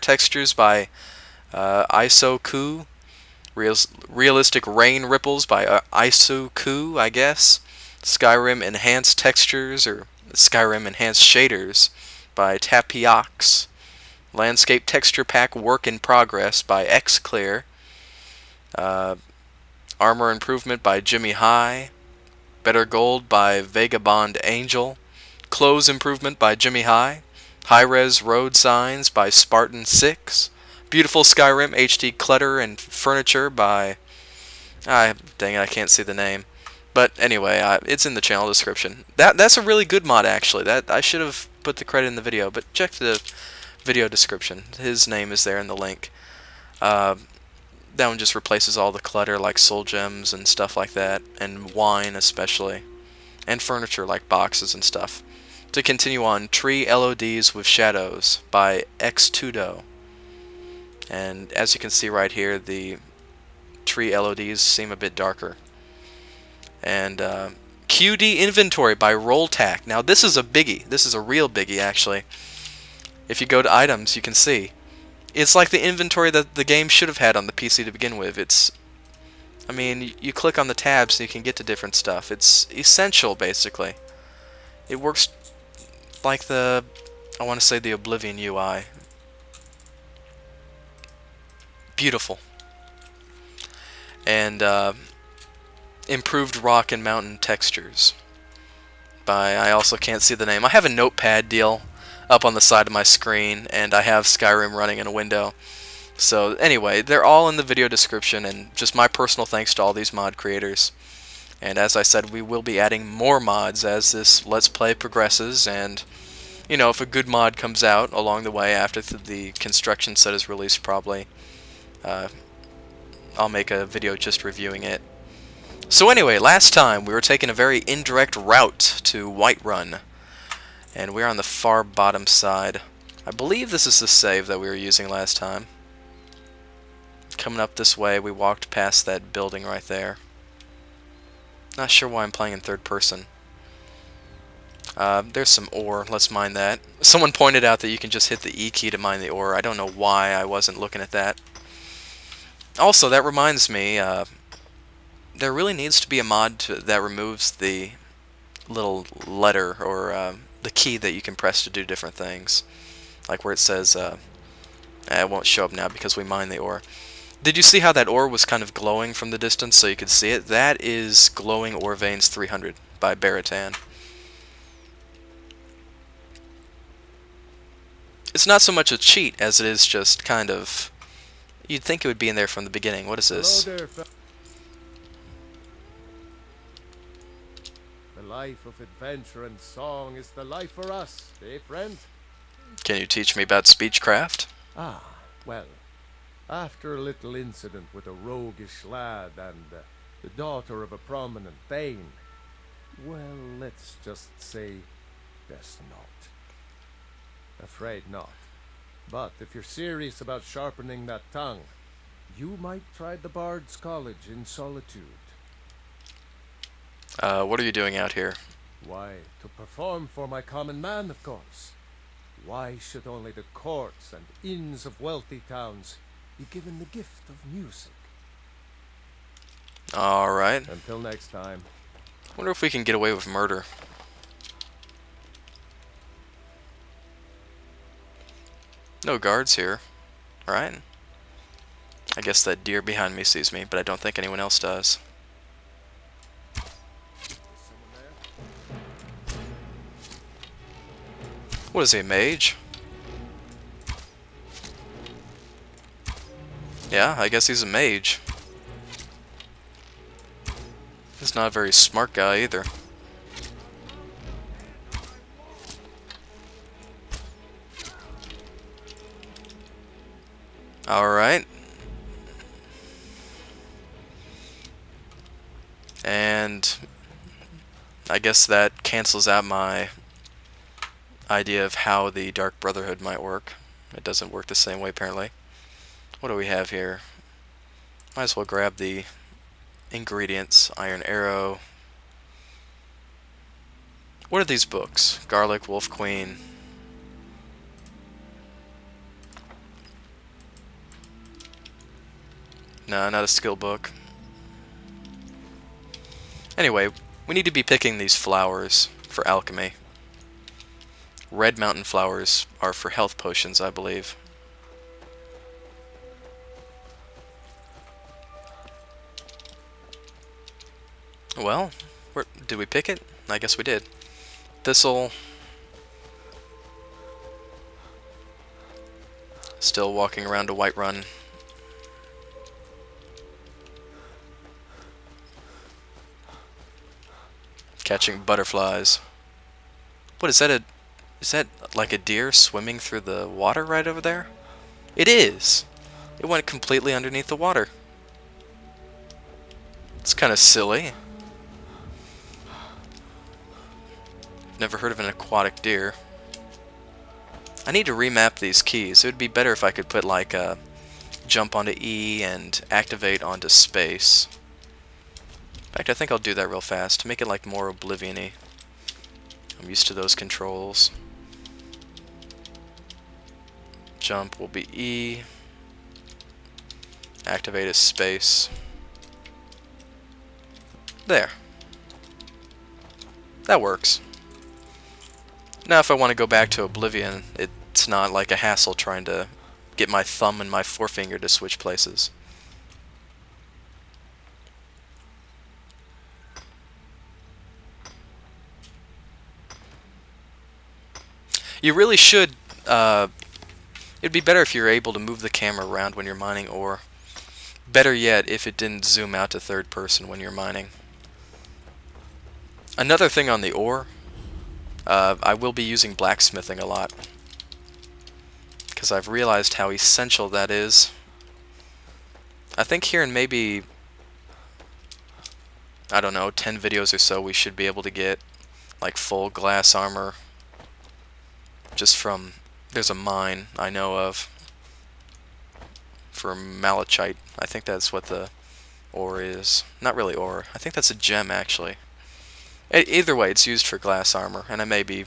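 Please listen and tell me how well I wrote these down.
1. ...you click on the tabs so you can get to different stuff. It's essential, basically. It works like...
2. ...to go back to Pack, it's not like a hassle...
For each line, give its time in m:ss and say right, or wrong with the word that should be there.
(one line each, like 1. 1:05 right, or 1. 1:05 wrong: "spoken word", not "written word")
1. 1:20 right
2. 6:26 wrong: "Oblivion", not "Pack".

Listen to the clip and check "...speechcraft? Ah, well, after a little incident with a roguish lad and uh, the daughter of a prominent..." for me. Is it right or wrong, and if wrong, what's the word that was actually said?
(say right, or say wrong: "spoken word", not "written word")
right.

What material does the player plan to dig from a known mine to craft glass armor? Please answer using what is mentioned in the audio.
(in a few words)
Malachite.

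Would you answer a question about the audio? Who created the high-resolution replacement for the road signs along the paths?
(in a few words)
Spartan 6.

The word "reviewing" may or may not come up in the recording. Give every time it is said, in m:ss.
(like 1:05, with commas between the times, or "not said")
2:04.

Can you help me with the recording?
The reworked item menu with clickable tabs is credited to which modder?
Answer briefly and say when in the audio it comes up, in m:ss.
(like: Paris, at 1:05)
Rolltac, at 1:09.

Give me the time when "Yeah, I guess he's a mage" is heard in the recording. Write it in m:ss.
4:16.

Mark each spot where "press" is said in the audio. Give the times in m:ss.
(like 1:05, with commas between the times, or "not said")
2:41.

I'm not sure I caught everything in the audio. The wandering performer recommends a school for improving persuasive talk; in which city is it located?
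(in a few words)
Solitude.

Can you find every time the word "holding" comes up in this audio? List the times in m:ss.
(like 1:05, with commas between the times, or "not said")
not said.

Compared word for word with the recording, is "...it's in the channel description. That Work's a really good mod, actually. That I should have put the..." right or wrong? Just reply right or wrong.
wrong.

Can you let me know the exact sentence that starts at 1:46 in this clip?
So anyway, they're all in the video description, and just my personal thanks to all these mod creators.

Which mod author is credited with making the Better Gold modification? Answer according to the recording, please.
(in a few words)
Vagabond Angel.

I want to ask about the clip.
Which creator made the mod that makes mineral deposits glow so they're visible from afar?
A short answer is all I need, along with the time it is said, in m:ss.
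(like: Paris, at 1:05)
Baratan, at 2:53.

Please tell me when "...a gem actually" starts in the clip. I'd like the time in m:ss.
7:20.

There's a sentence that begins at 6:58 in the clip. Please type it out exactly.
Because I've realized how essential that is.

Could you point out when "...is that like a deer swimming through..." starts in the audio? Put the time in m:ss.
5:41.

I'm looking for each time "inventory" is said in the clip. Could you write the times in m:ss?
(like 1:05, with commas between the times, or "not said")
1:08, 1:15.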